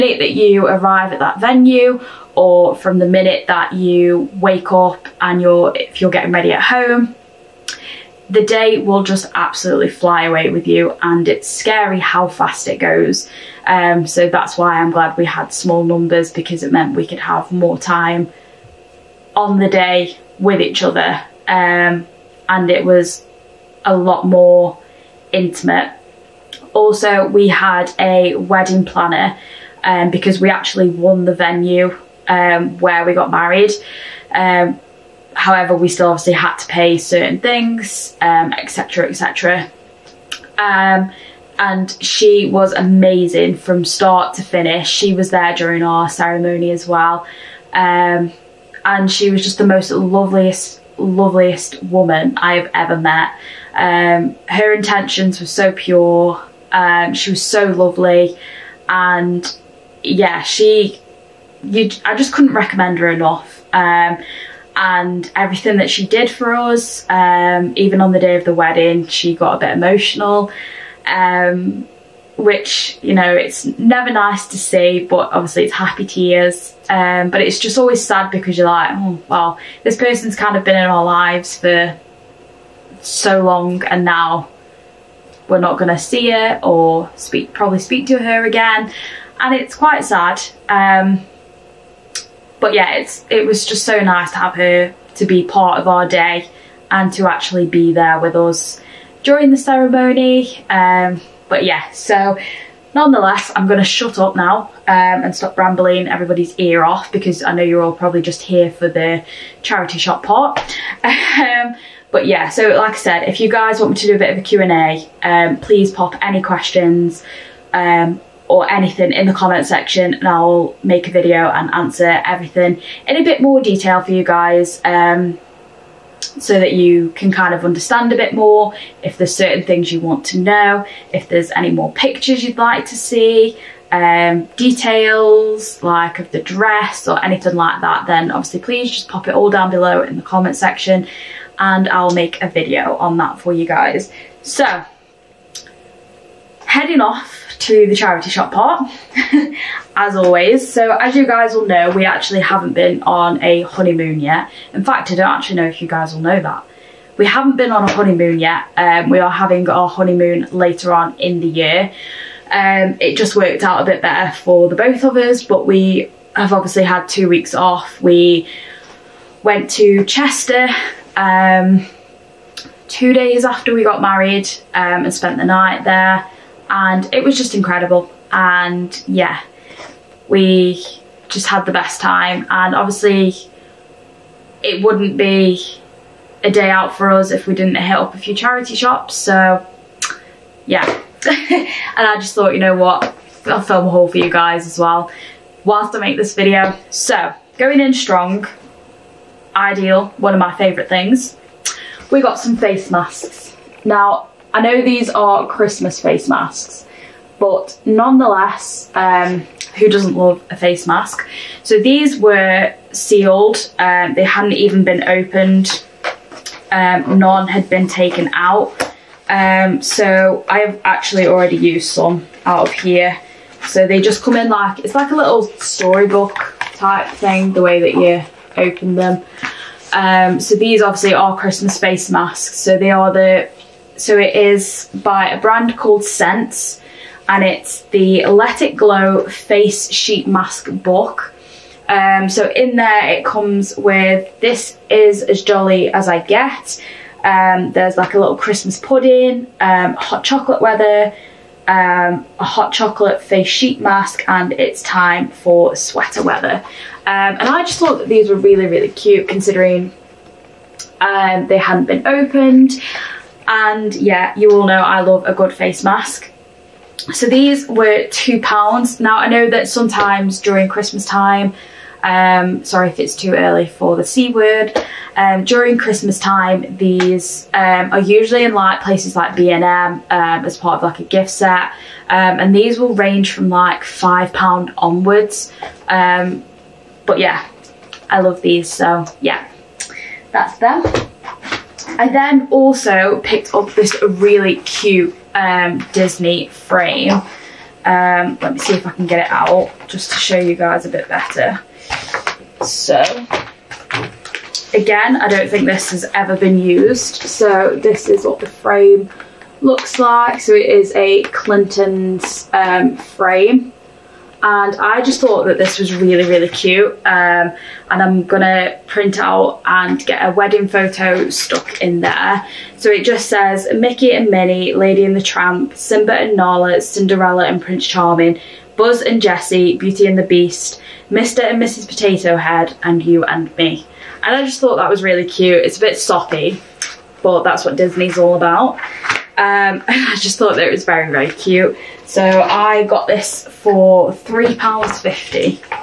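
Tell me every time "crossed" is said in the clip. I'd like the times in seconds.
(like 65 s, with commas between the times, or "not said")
not said.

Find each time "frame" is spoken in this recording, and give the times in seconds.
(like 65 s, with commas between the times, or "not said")
296 s, 308 s, 312 s.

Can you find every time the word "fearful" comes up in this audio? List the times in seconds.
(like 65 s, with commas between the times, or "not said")
not said.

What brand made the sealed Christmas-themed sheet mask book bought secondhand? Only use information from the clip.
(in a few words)
Sense.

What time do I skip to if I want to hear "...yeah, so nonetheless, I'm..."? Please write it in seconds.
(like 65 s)
101 s.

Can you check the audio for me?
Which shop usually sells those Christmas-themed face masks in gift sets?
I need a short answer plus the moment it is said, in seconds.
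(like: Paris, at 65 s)
B&M, at 279 s.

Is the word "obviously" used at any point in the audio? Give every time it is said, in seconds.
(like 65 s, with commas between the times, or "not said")
36 s, 75 s, 138 s, 166 s, 182 s, 230 s.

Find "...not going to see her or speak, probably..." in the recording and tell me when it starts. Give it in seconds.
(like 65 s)
85 s.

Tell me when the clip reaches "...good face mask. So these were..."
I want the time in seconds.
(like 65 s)
265 s.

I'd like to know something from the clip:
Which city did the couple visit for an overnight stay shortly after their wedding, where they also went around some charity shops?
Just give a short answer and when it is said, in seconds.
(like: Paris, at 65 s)
Chester, at 170 s.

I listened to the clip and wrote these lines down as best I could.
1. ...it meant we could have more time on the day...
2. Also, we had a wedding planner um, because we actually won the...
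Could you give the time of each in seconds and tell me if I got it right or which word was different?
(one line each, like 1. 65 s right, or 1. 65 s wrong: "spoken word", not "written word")
1. 16 s right
2. 26 s right.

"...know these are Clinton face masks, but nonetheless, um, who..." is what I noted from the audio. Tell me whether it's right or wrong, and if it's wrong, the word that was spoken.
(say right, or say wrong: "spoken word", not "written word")
wrong: "Christmas", not "Clinton".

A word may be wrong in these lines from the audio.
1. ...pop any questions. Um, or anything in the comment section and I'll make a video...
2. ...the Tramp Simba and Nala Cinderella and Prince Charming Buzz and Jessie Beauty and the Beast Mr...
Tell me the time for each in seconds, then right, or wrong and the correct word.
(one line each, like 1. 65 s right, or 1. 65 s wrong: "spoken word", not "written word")
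1. 115 s right
2. 325 s right.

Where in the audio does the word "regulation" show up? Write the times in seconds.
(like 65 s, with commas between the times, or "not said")
not said.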